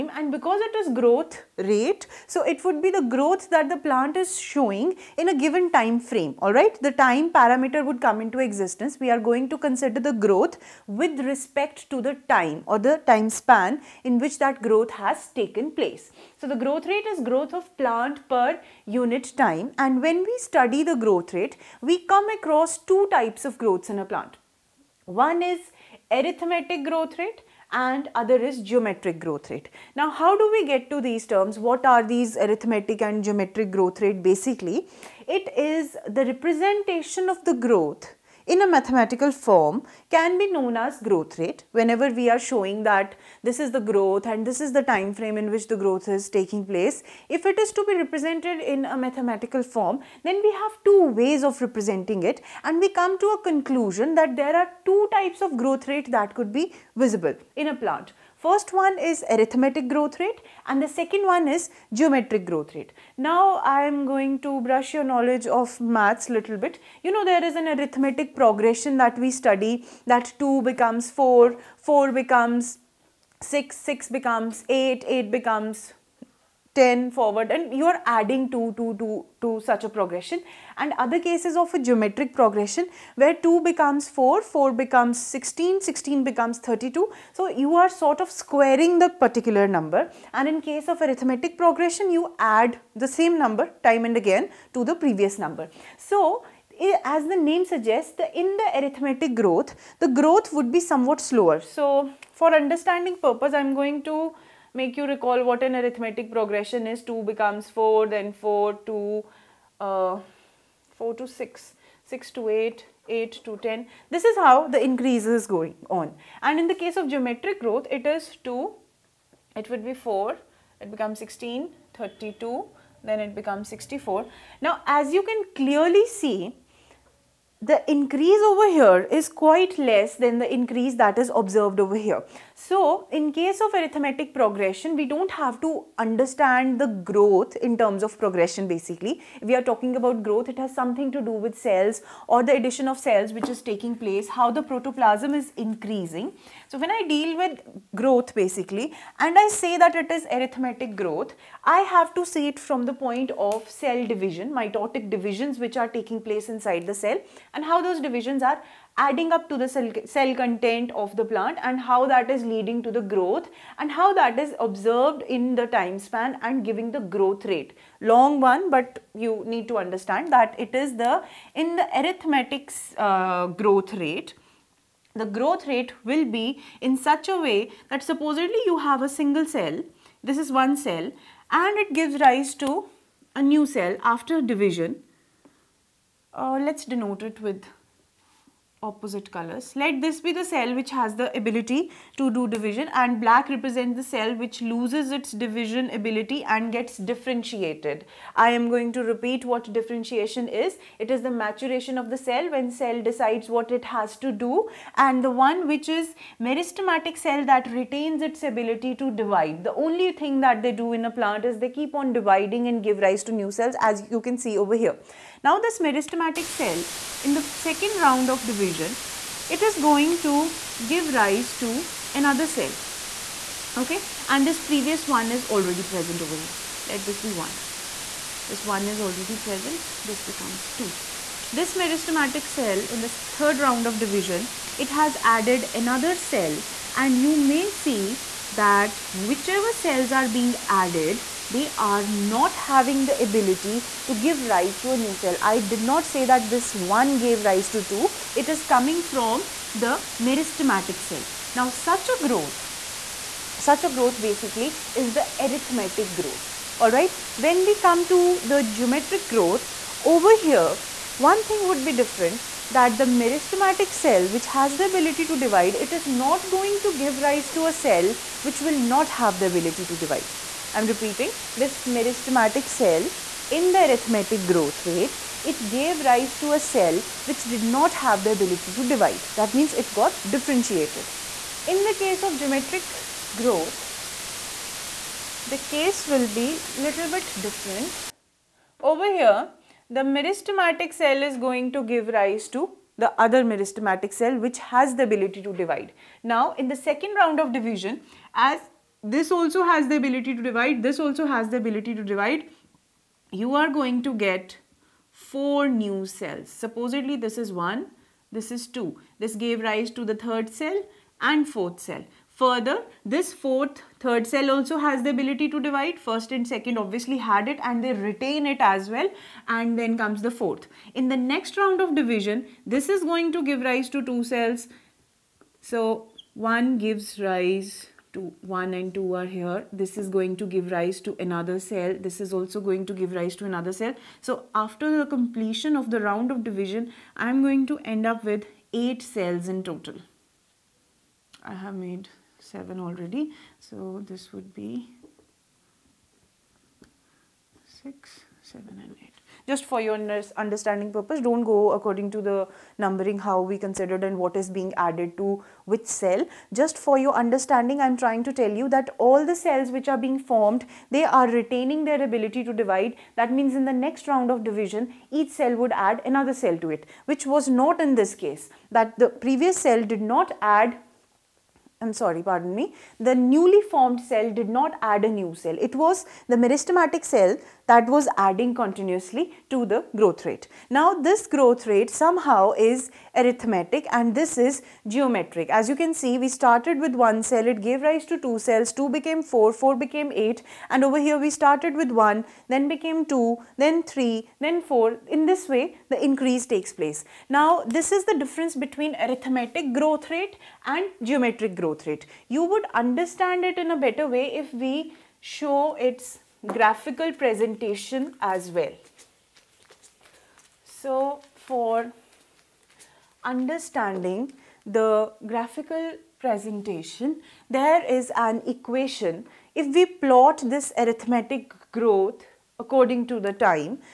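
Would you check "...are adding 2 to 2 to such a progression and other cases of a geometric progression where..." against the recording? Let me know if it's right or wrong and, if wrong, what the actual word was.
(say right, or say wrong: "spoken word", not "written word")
right.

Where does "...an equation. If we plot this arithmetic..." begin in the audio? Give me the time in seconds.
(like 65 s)
418 s.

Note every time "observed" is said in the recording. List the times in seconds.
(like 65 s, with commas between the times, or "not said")
131 s, 164 s.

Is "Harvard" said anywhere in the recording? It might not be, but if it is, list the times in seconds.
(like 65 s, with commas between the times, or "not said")
not said.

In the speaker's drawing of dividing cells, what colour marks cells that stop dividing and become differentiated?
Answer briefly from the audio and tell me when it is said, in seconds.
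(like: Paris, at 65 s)
Black, at 193 s.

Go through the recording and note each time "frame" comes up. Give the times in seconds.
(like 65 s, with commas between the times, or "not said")
6 s, 45 s.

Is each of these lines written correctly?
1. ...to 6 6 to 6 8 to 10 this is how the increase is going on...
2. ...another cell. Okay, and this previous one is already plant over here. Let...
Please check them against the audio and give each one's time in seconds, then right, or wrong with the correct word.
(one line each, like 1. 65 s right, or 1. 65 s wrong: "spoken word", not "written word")
1. 111 s wrong: "8", not "6"
2. 222 s wrong: "present", not "plant".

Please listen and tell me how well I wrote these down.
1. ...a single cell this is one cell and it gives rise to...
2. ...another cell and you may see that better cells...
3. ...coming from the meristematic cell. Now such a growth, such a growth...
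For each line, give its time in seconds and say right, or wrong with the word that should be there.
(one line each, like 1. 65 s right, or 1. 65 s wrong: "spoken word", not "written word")
1. 179 s right
2. 235 s wrong: "whichever", not "better"
3. 248 s right.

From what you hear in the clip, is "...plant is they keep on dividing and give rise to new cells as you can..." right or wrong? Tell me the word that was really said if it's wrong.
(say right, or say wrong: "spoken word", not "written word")
right.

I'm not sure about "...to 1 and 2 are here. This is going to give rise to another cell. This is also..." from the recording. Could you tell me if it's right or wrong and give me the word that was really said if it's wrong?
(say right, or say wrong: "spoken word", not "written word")
right.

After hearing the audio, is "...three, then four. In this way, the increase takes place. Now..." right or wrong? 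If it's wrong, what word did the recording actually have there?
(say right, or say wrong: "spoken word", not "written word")
right.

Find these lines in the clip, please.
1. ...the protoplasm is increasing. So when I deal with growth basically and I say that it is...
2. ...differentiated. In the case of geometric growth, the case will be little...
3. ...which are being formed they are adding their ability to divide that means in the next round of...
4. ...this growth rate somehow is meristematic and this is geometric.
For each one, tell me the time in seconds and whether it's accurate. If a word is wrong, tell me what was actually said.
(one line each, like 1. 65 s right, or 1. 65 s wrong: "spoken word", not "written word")
1. 144 s right
2. 280 s right
3. 359 s wrong: "retaining", not "adding"
4. 380 s wrong: "arithmetic", not "meristematic".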